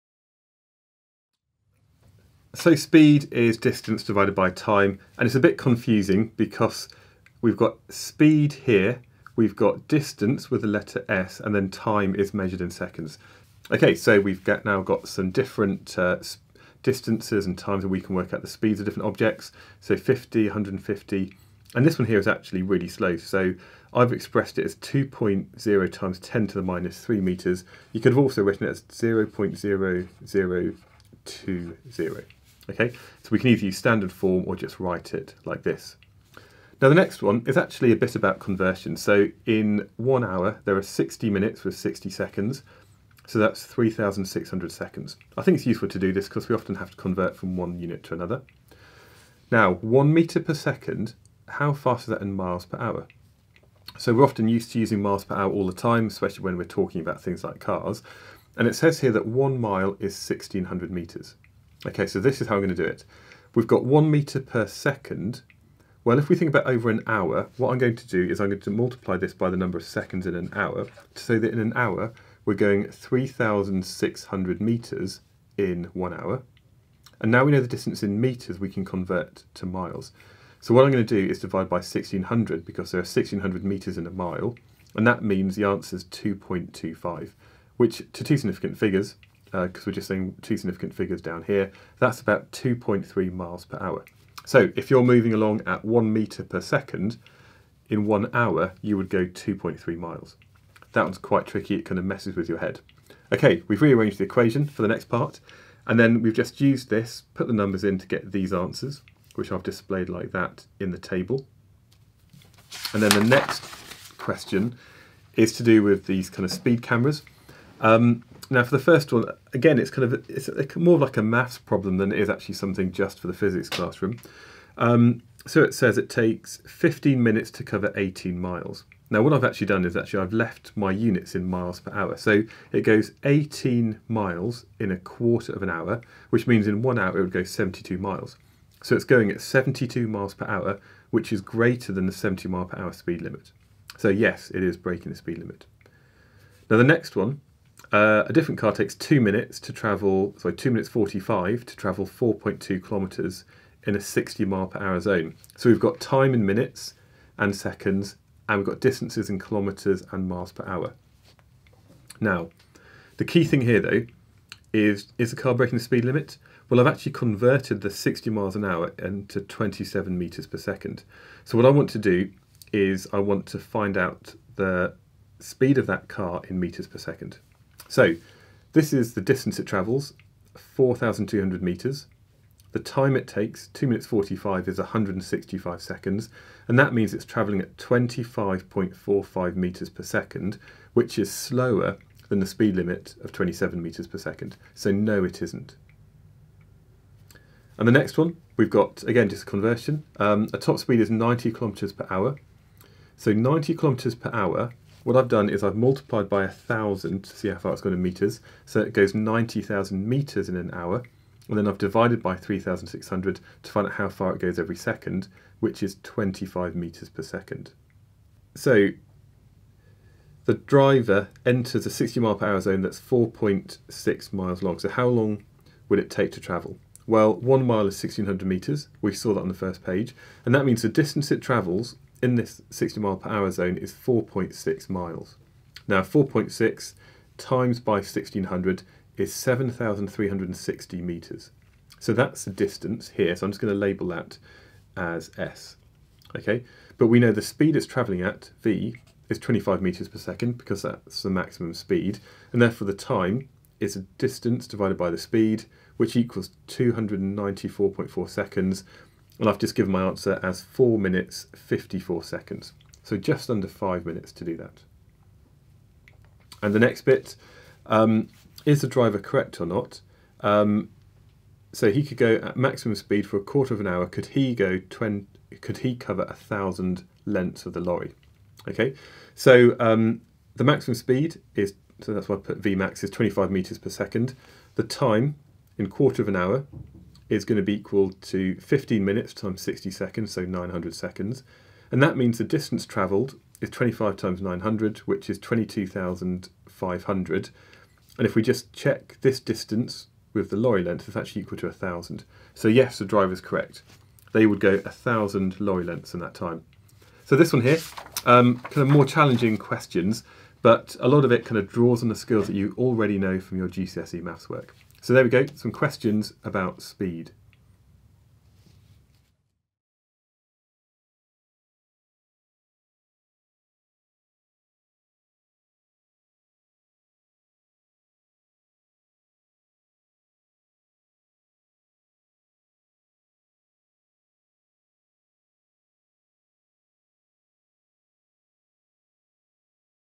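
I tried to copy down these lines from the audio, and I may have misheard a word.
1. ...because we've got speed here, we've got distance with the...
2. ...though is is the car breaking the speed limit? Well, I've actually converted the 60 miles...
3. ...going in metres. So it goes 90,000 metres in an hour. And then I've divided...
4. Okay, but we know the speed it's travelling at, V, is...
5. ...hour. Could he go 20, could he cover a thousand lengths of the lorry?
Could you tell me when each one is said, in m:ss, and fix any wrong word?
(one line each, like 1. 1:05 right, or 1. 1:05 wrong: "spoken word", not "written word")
1. 0:06 right
2. 2:43 right
3. 3:27 right
4. 4:06 right
5. 4:33 right.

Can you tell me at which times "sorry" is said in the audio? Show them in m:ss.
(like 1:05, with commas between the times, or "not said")
2:30.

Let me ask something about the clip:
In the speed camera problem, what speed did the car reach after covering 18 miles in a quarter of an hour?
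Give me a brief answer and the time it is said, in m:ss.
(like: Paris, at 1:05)
72 miles per hour, at 2:19.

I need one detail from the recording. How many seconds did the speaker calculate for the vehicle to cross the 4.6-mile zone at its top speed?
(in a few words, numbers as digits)
294.4 seconds.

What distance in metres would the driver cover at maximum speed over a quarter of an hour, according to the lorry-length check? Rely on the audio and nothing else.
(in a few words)
22,500.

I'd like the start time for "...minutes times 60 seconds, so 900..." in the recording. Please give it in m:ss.
4:49.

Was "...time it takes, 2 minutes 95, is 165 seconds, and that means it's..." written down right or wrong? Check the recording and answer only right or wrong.
wrong.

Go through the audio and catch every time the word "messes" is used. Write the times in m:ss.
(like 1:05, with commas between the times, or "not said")
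1:42.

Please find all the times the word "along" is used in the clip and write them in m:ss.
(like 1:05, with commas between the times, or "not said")
1:35.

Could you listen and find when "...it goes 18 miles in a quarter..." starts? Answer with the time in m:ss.
2:12.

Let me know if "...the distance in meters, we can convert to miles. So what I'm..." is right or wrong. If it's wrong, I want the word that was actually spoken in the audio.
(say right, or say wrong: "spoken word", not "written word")
right.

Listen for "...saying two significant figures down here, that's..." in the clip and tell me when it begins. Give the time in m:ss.
1:30.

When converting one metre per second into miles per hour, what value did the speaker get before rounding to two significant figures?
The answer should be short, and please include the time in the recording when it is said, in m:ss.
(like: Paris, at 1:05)
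2.25, at 1:26.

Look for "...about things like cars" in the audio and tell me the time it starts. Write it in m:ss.
0:57.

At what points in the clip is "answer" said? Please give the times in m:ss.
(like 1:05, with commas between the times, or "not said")
1:25, 1:48, 4:20.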